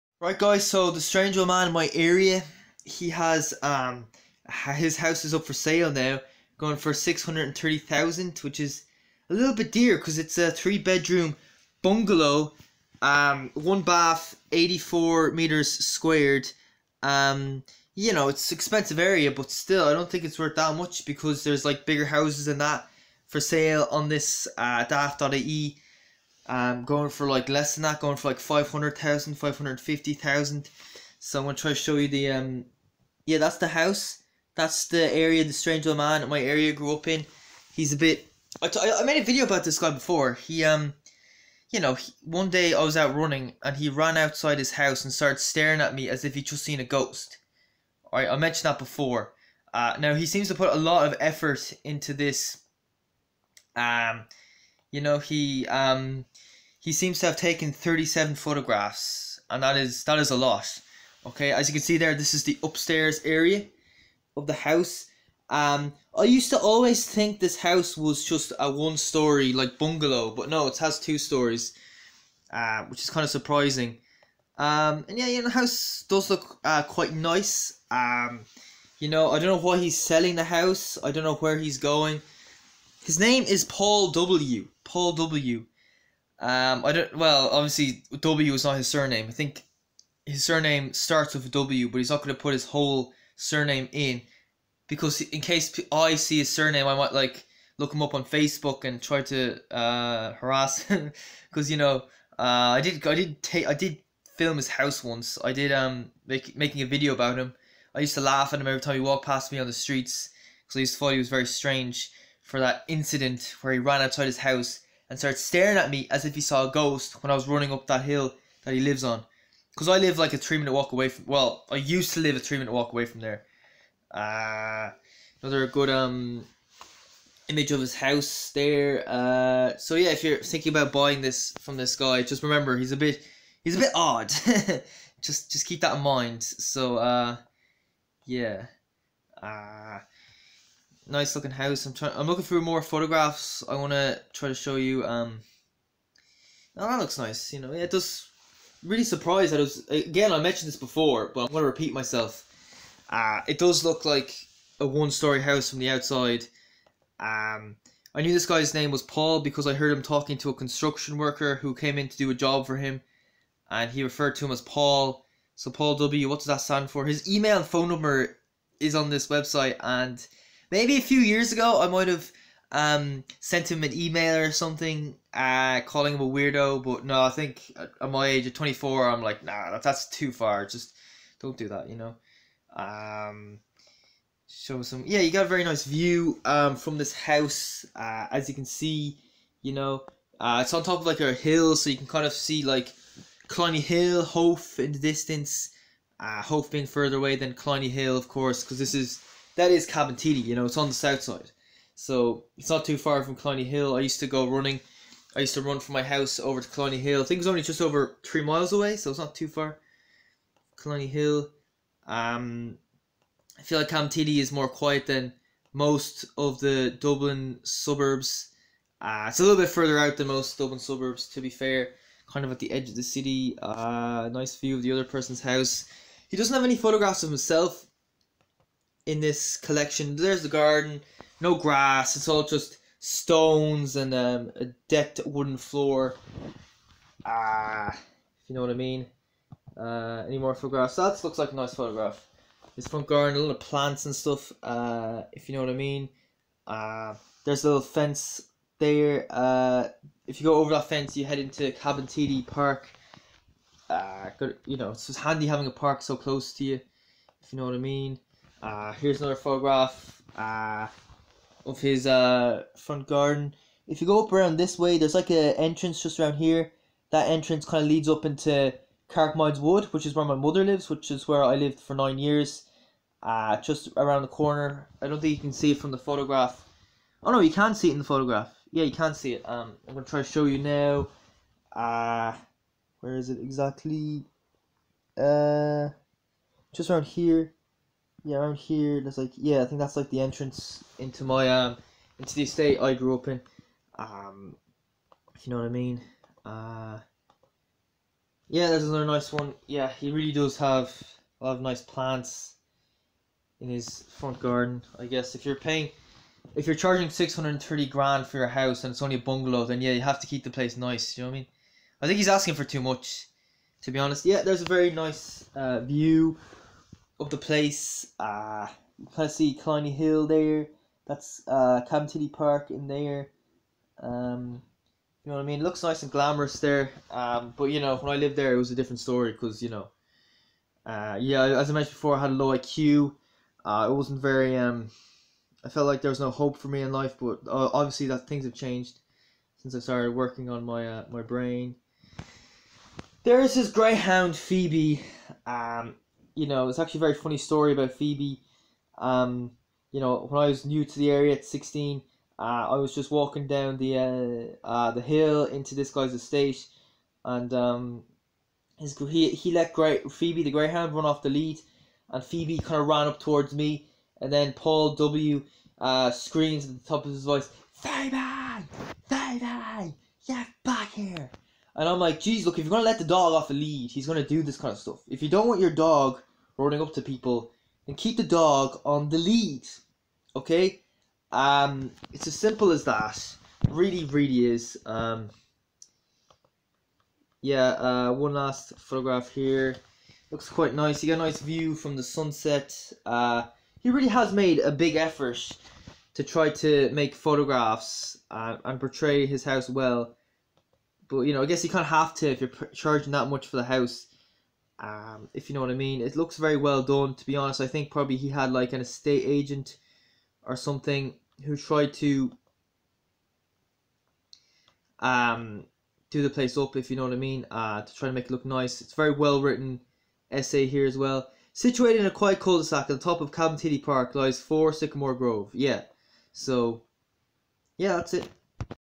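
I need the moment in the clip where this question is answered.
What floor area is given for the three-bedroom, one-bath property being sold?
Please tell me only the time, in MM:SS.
00:14.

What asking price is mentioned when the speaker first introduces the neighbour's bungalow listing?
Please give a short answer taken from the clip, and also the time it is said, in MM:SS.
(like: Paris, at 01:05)
630,000, at 00:06.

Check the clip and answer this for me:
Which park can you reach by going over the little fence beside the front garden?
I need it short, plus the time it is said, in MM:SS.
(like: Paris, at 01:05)
TD Park, at 04:11.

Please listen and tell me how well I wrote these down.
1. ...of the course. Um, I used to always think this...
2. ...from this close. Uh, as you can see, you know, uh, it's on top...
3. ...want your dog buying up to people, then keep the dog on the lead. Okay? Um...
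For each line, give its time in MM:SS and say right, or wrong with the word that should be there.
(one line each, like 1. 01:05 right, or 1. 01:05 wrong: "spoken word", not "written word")
1. 01:04 wrong: "house", not "course"
2. 03:06 wrong: "house", not "close"
3. 06:15 wrong: "running", not "buying".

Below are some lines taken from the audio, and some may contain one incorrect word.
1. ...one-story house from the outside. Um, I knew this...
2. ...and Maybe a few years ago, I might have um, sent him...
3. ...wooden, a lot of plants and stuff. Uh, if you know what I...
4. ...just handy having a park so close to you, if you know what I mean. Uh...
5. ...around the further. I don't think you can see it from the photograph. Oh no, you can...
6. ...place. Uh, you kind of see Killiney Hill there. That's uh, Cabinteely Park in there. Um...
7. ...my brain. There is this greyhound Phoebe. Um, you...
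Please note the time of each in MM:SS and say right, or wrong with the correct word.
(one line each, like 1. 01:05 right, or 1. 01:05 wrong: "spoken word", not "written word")
1. 02:34 right
2. 02:49 right
3. 04:03 wrong: "garden", not "wooden"
4. 04:15 right
5. 04:33 wrong: "corner", not "further"
6. 05:17 right
7. 05:41 right.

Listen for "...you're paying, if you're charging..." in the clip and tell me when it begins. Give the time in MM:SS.
05:05.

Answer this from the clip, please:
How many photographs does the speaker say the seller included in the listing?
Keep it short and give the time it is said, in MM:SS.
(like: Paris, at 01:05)
37, at 00:57.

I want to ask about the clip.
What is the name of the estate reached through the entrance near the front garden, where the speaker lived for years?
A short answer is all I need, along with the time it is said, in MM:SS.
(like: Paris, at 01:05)
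Carrickmines Wood, at 04:29.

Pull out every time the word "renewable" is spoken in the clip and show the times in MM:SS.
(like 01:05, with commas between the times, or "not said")
not said.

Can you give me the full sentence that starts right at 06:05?
Uh, screams at the top of his voice, Phoebe, Phoebe, get back here!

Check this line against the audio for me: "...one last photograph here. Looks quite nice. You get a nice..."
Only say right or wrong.
right.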